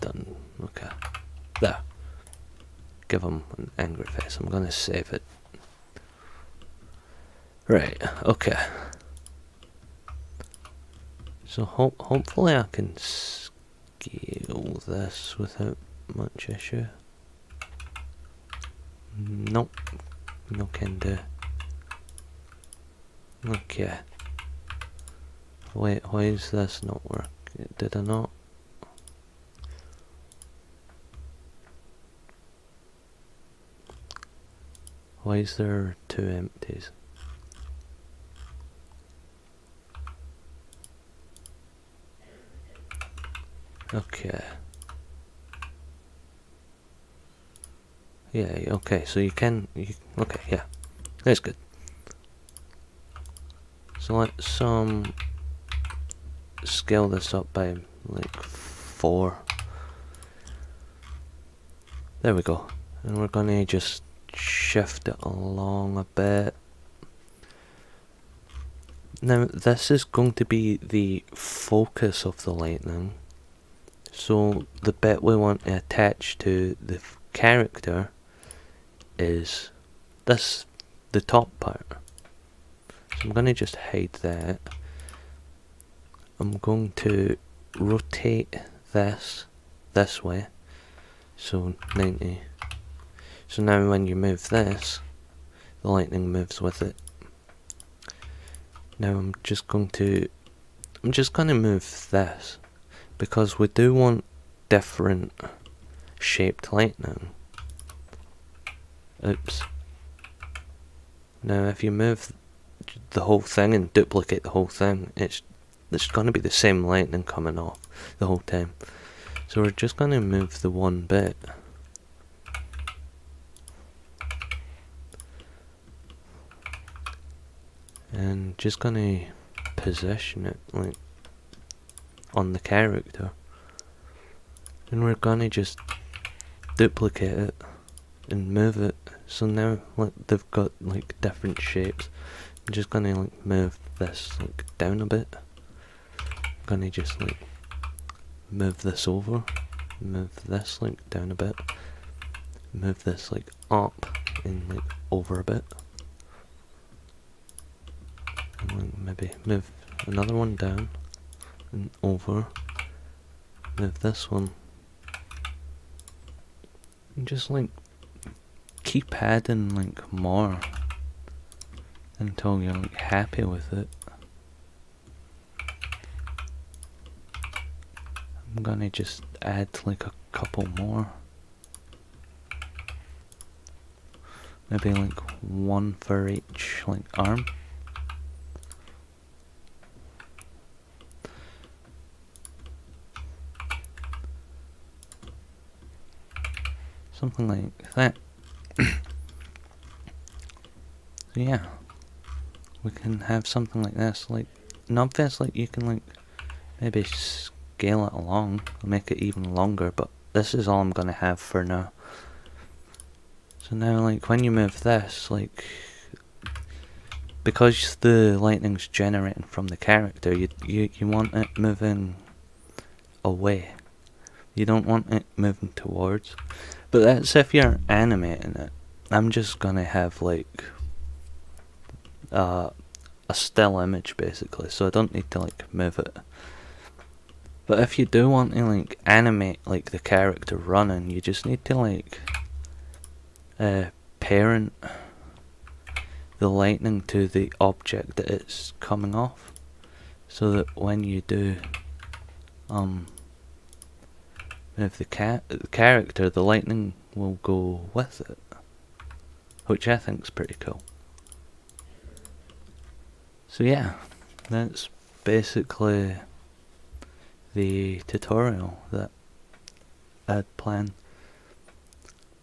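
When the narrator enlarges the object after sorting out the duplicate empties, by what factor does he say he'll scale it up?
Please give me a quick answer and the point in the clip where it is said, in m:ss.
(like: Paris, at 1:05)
4, at 0:58.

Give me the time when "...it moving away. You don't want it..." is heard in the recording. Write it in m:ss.
3:41.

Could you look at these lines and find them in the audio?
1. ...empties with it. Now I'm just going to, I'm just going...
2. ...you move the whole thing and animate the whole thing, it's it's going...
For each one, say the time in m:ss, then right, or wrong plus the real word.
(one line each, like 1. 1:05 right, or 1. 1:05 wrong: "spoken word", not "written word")
1. 1:36 wrong: "moves", not "empties"
2. 1:51 wrong: "duplicate", not "animate".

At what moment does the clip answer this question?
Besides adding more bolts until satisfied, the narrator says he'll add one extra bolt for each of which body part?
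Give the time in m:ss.
3:07.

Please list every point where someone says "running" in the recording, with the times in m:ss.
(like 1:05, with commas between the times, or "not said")
4:00.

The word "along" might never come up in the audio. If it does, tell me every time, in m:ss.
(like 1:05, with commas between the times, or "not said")
1:05, 3:28.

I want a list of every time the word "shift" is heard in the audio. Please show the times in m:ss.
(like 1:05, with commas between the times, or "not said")
1:04.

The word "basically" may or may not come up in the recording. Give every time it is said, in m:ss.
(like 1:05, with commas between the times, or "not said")
3:54, 4:25.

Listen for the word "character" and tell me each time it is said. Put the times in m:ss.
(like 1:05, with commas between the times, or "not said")
1:17, 2:12, 3:39, 3:59, 4:15.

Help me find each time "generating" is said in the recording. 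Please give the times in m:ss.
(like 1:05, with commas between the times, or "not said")
3:38.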